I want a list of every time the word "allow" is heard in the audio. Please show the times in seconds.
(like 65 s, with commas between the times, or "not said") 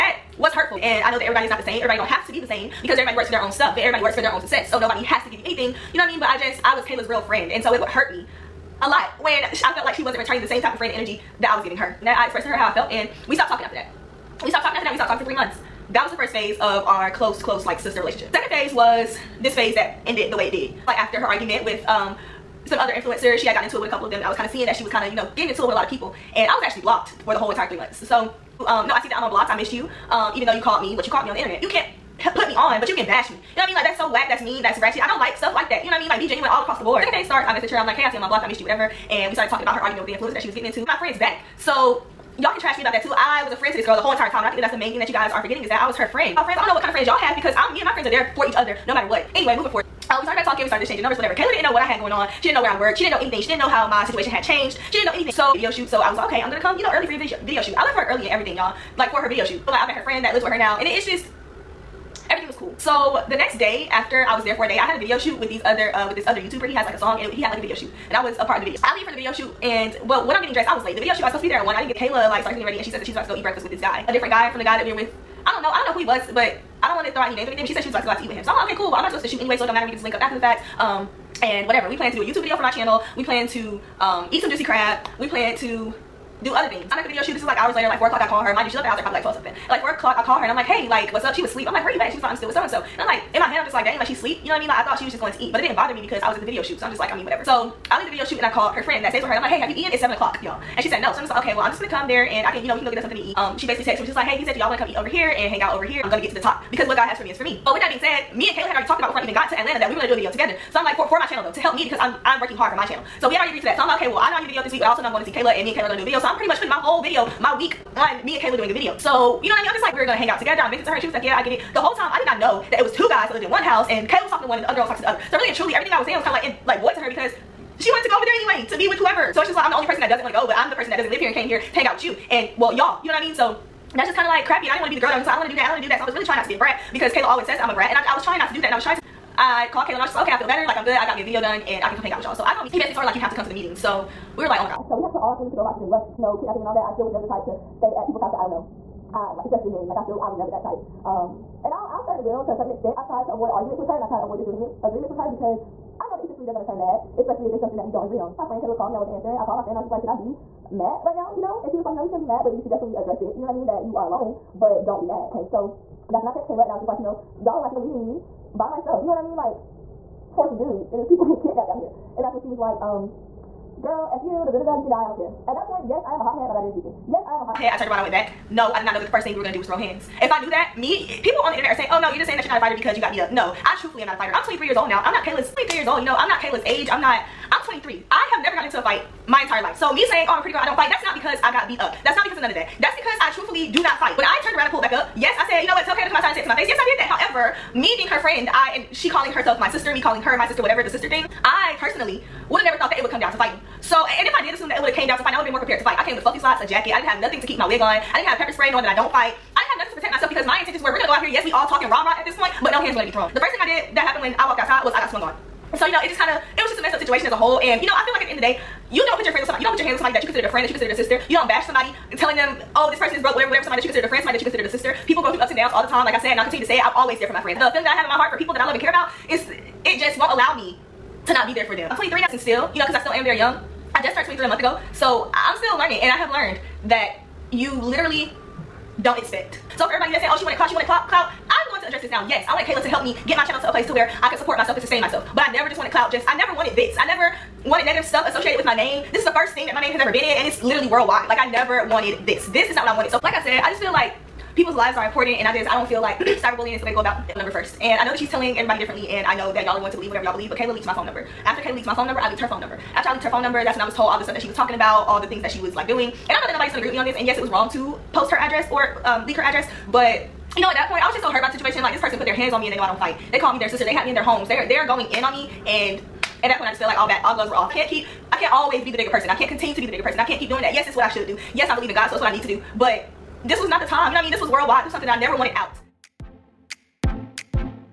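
230 s.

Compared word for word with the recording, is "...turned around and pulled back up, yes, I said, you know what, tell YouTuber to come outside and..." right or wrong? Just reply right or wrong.
wrong.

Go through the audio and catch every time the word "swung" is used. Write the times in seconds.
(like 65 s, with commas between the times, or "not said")
215 s.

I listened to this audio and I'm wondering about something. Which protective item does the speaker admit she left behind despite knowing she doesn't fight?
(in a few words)
Pepper spray.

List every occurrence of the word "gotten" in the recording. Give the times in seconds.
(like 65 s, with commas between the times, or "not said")
23 s, 188 s.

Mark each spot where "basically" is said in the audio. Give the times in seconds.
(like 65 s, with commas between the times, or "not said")
103 s, 142 s.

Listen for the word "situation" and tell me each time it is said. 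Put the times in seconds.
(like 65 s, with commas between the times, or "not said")
54 s, 216 s, 271 s.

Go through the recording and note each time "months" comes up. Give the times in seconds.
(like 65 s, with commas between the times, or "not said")
15 s, 27 s, 234 s.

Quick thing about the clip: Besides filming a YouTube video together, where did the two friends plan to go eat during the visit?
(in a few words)
Juicy Crab.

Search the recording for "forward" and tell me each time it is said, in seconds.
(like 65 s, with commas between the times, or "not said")
49 s.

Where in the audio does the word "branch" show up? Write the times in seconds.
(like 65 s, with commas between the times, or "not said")
not said.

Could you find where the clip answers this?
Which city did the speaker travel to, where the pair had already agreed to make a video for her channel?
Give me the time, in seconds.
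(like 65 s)
109 s.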